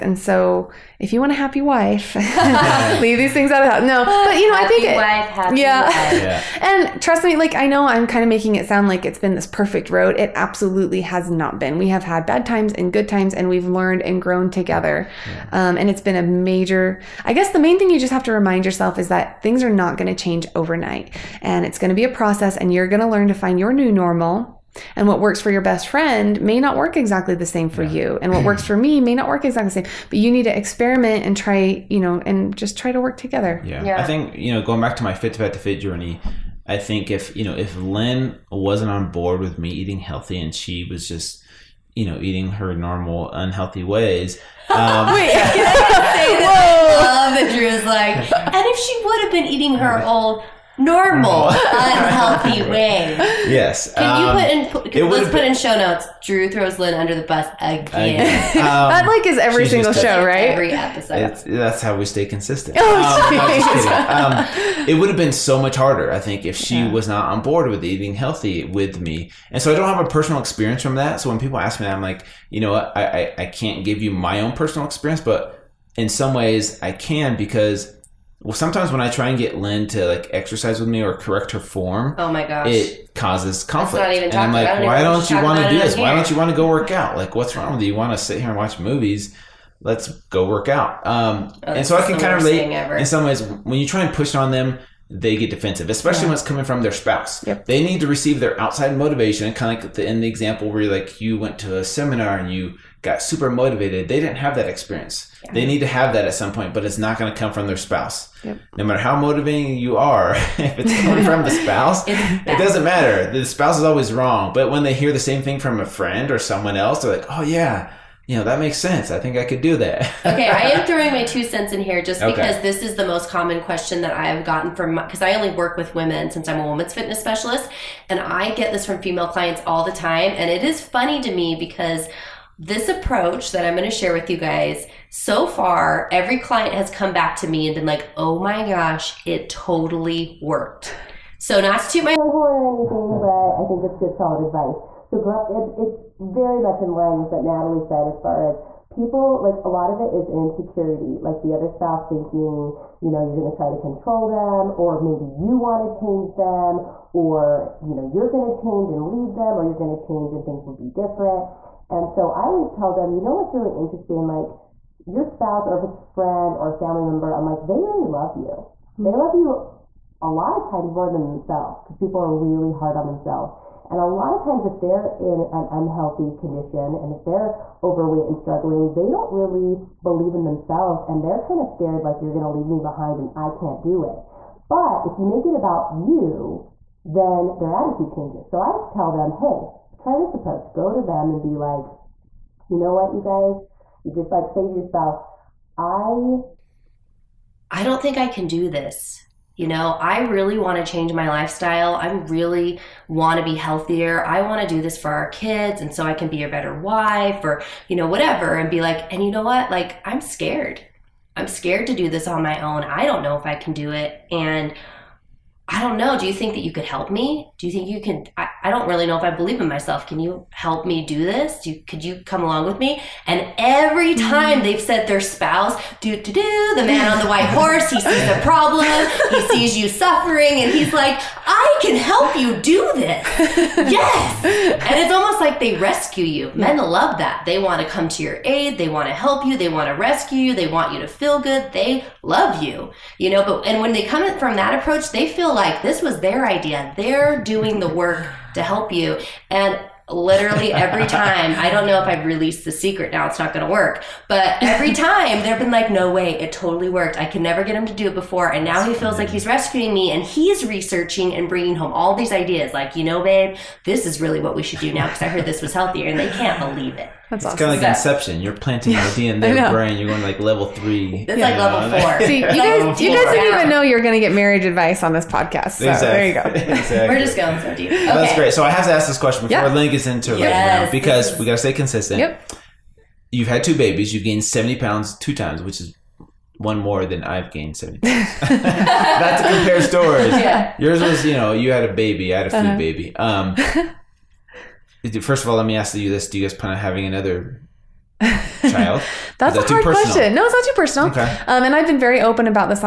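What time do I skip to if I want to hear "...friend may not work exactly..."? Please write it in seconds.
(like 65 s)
25 s.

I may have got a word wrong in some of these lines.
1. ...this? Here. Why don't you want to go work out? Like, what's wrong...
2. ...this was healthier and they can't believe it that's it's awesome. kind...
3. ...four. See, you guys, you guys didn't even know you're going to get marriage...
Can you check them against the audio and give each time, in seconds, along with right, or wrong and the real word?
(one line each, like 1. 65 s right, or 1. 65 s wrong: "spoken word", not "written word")
1. 85 s right
2. 265 s right
3. 272 s right.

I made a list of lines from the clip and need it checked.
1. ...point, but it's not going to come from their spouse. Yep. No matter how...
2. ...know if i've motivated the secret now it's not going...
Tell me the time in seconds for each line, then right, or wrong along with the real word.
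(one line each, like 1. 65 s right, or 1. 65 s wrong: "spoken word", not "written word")
1. 106 s right
2. 251 s wrong: "released", not "motivated".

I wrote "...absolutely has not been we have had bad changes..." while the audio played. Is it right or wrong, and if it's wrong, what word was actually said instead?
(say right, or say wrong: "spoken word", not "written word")
wrong: "times", not "changes".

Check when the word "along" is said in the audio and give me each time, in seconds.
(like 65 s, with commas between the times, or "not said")
222 s.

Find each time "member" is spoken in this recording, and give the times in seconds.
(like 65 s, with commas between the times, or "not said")
167 s.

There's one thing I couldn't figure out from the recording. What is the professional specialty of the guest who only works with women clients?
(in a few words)
women's fitness specialist.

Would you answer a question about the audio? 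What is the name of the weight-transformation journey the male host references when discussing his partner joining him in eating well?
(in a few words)
Fit to Fat to Fit.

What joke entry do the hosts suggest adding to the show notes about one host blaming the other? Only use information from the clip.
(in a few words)
Drew throws Lynn under the bus.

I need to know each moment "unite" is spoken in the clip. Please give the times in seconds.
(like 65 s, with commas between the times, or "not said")
not said.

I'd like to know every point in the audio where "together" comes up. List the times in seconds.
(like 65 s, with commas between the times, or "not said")
14 s, 33 s.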